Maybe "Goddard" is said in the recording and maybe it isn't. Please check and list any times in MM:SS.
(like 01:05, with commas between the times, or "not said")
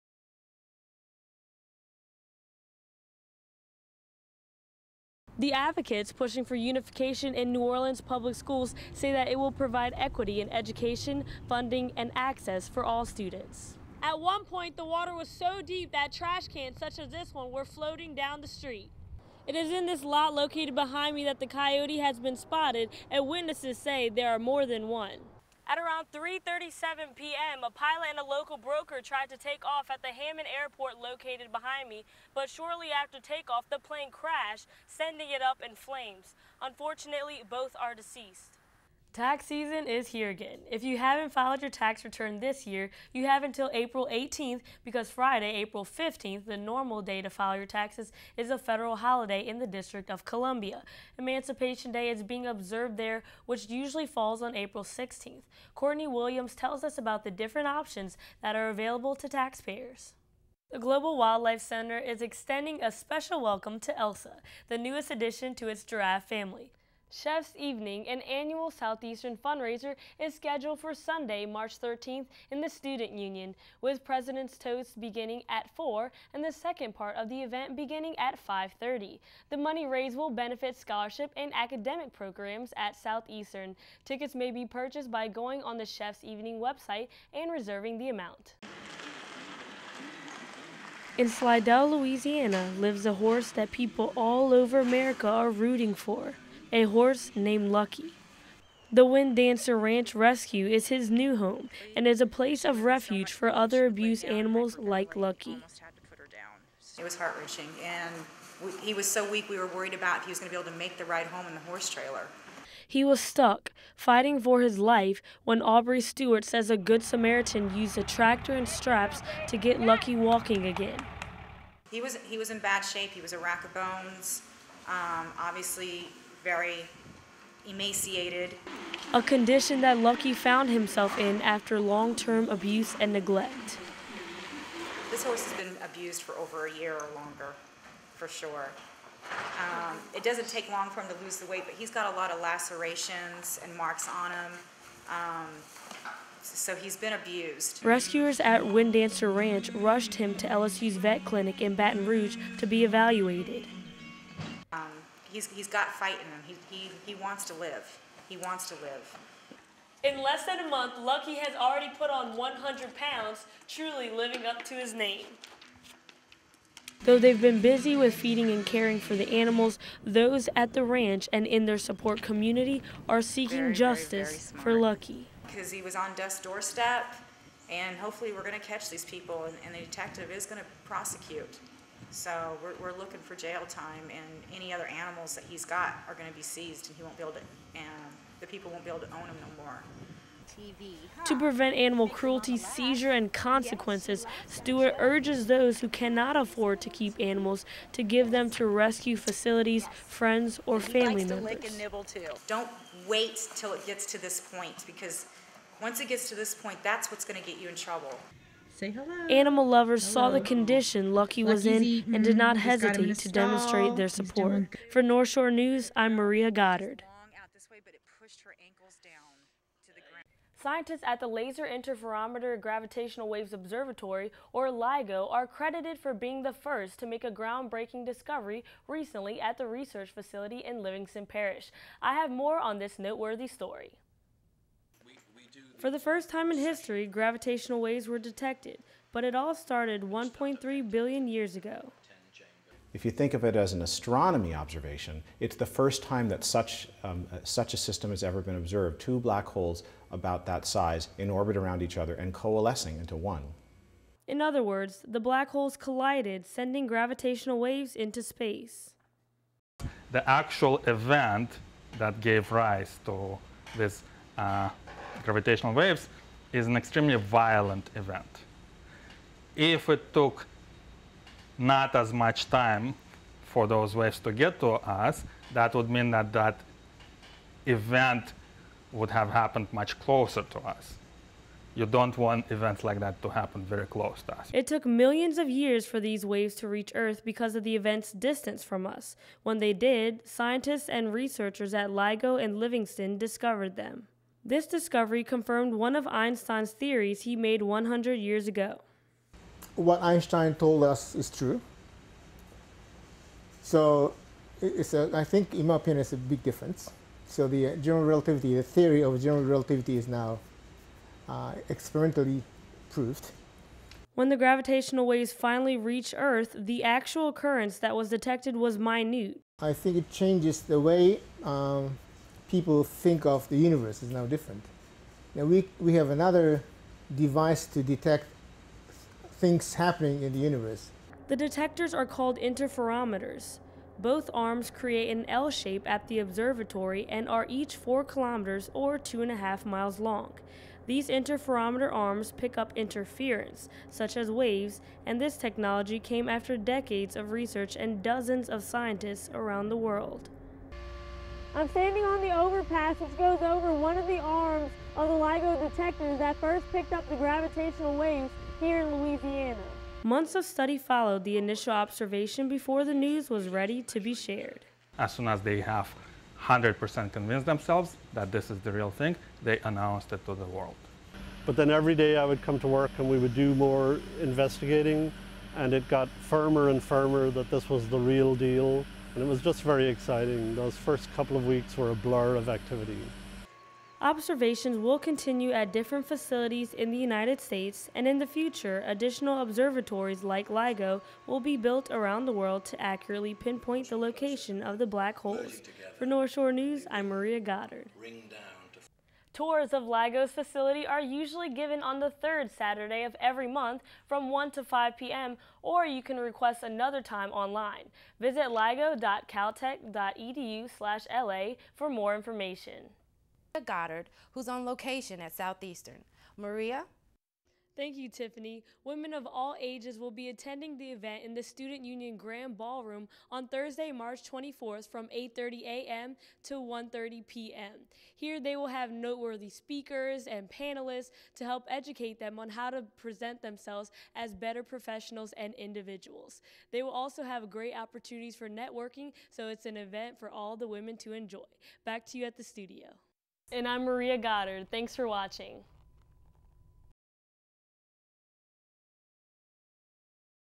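03:36, 06:37, 06:53, 07:24.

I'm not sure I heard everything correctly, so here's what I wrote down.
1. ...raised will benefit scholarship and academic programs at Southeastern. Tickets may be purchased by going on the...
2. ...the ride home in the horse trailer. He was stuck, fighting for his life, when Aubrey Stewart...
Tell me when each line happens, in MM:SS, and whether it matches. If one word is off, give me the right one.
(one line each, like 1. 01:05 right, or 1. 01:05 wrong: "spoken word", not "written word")
1. 01:19 right
2. 01:50 right.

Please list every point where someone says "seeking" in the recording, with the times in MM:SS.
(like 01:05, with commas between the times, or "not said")
02:53.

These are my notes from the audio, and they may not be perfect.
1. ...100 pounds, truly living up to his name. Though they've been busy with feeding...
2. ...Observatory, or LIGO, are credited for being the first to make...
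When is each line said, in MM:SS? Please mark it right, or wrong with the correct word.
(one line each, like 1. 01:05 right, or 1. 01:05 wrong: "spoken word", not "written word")
1. 02:42 right
2. 03:43 right.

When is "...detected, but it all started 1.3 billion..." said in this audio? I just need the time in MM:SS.
03:58.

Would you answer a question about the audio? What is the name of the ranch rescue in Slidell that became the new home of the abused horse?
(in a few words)
Wind Dancer Ranch Rescue.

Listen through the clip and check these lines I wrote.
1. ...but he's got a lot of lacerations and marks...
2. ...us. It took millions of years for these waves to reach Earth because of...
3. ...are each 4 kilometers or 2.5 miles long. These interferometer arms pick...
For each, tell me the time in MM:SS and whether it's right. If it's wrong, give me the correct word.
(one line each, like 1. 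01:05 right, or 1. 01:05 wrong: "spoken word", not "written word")
1. 02:21 right
2. 04:44 right
3. 05:37 right.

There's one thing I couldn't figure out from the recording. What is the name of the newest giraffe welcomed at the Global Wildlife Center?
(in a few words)
Elsa.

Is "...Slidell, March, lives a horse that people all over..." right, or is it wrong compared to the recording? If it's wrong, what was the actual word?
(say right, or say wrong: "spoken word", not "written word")
wrong: "Louisiana", not "March".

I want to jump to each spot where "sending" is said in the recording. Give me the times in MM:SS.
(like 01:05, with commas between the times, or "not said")
00:34, 04:16.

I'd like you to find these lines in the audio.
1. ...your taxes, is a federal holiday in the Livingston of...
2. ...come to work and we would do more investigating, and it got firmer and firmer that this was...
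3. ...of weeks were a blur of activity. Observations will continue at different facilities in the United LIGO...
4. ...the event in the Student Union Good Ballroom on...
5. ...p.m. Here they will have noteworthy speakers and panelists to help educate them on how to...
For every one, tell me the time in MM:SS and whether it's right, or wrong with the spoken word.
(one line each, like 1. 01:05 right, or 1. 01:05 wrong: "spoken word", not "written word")
1. 00:47 wrong: "District", not "Livingston"
2. 06:12 right
3. 06:21 wrong: "States", not "LIGO"
4. 07:00 wrong: "Grand", not "Good"
5. 07:07 right.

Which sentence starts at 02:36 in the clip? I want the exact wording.
He, he, he wants to live.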